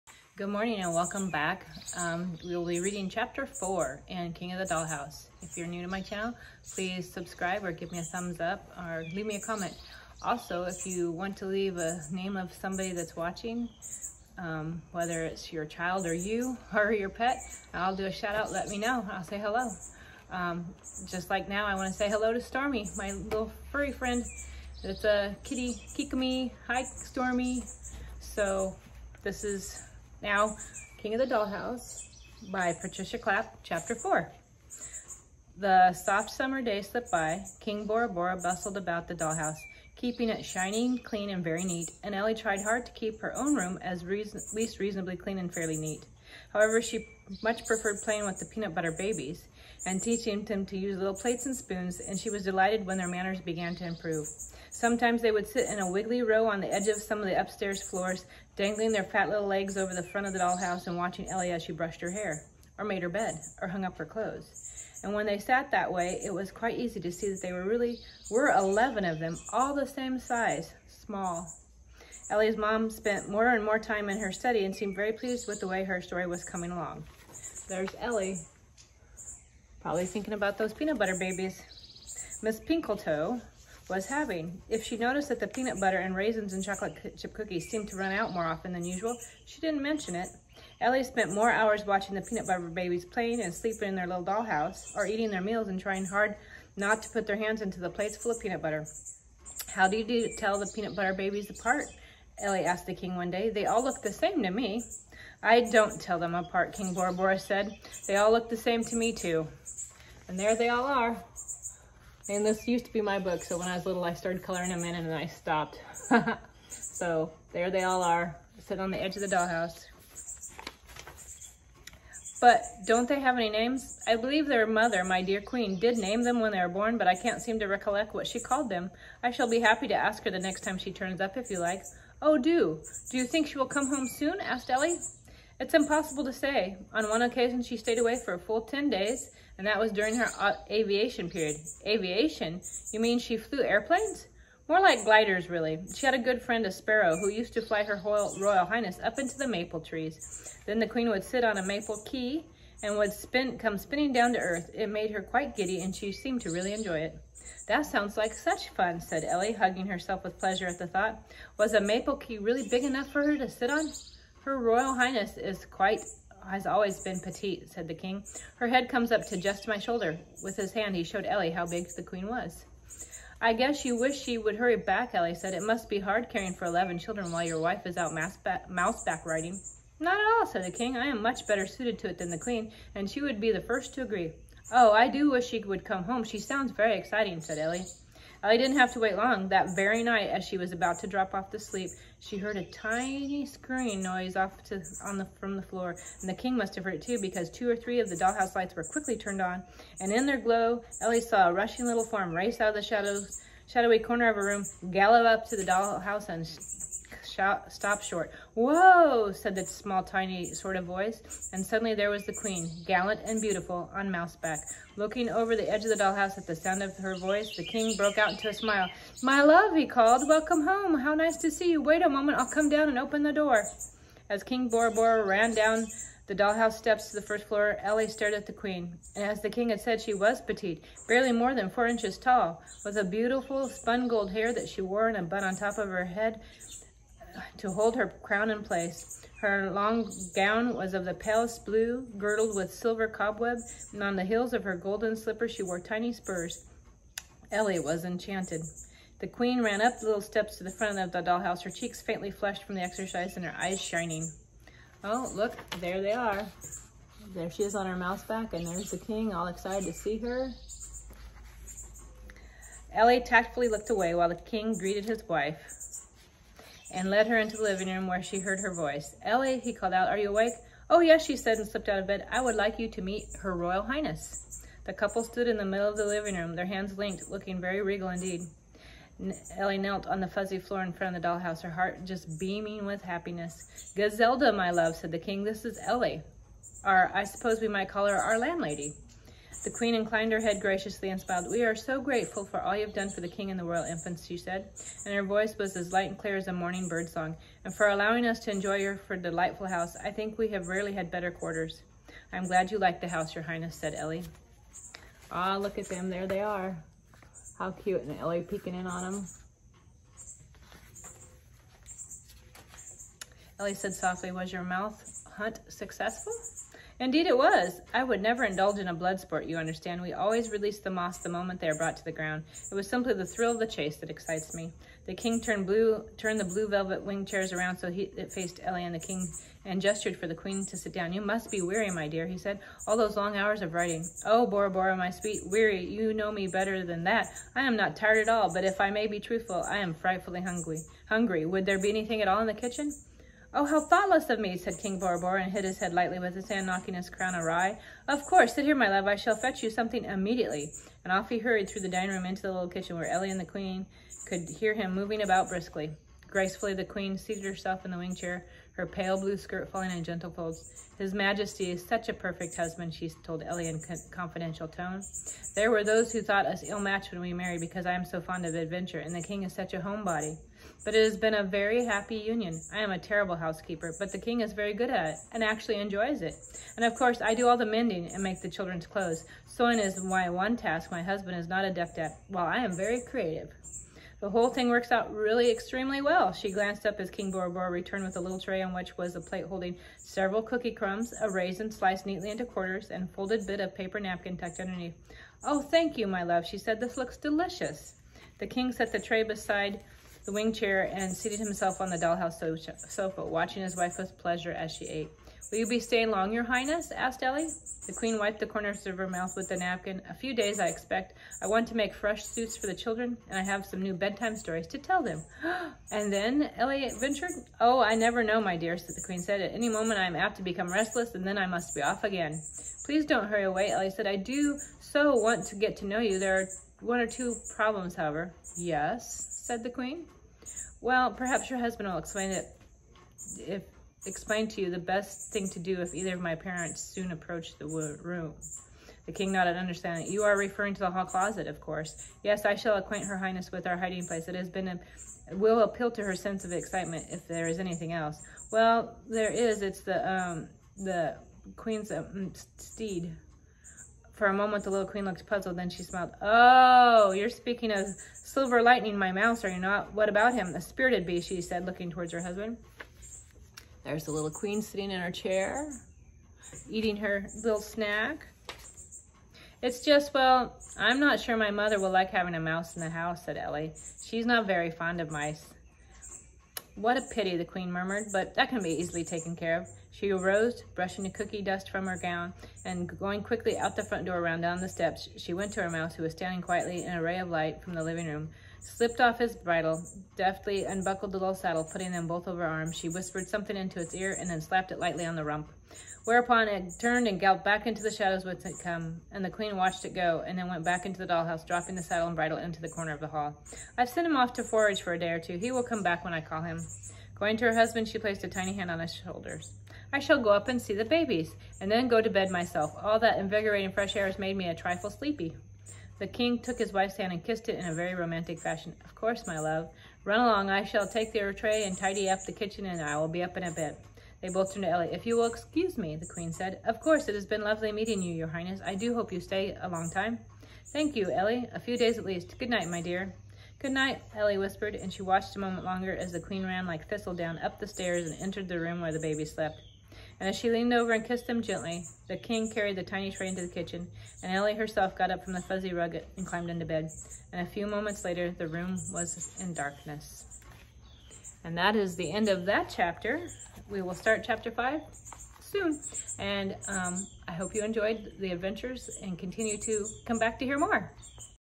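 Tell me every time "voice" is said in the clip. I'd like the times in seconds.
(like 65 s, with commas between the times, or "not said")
210 s, 217 s, 268 s, 295 s.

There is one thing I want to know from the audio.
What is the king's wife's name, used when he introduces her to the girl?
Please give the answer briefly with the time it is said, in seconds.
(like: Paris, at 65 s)
Gazelda, at 283 s.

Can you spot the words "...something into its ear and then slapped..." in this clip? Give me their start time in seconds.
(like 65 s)
493 s.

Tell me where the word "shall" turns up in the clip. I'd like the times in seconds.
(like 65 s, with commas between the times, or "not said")
129 s, 349 s, 442 s, 509 s, 520 s.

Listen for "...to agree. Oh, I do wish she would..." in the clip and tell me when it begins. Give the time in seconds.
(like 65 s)
183 s.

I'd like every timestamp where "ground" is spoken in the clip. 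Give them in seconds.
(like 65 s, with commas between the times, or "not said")
322 s.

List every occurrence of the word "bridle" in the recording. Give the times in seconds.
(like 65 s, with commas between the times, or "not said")
489 s, 502 s.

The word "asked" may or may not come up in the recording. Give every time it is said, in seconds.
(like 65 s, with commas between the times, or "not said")
102 s, 134 s, 406 s.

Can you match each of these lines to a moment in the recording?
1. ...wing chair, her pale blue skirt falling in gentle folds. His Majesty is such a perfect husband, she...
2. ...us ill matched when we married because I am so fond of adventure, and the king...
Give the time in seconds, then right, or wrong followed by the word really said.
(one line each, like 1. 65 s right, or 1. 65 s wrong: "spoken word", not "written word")
1. 357 s right
2. 366 s right.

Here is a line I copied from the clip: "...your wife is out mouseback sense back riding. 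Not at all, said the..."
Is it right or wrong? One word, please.
wrong.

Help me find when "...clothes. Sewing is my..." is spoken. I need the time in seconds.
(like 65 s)
378 s.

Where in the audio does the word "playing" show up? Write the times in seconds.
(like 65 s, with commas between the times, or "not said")
48 s, 93 s.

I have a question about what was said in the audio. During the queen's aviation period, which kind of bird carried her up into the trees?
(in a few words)
A sparrow.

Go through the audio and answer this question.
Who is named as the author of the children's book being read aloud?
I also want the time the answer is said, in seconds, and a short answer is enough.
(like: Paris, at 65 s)
Patricia Clapp, at 32 s.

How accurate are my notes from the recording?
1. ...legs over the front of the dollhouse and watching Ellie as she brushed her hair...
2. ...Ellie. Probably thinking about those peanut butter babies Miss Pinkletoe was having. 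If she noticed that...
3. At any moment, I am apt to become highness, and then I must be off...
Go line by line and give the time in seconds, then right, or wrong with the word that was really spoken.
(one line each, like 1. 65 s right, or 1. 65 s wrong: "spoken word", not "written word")
1. 59 s right
2. 77 s right
3. 419 s wrong: "restless", not "highness".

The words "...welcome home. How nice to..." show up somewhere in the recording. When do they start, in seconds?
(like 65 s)
220 s.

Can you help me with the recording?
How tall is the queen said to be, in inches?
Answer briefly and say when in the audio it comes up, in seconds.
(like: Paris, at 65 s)
4, at 231 s.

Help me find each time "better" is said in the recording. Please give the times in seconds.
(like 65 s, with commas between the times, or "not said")
181 s, 301 s, 336 s.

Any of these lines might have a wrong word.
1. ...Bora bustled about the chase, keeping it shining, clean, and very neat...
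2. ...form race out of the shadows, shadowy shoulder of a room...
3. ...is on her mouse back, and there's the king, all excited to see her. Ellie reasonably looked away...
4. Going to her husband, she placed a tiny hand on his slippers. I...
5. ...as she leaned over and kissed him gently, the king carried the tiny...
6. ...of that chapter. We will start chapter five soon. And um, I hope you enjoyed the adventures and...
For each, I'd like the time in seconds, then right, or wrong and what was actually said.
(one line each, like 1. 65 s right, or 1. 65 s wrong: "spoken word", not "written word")
1. 38 s wrong: "dollhouse", not "chase"
2. 202 s wrong: "corner", not "shoulder"
3. 257 s wrong: "tactfully", not "reasonably"
4. 507 s wrong: "shoulders", not "slippers"
5. 540 s right
6. 552 s right.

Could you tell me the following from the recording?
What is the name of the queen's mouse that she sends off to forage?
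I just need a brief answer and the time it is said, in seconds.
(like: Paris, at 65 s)
Silver Lightning, at 458 s.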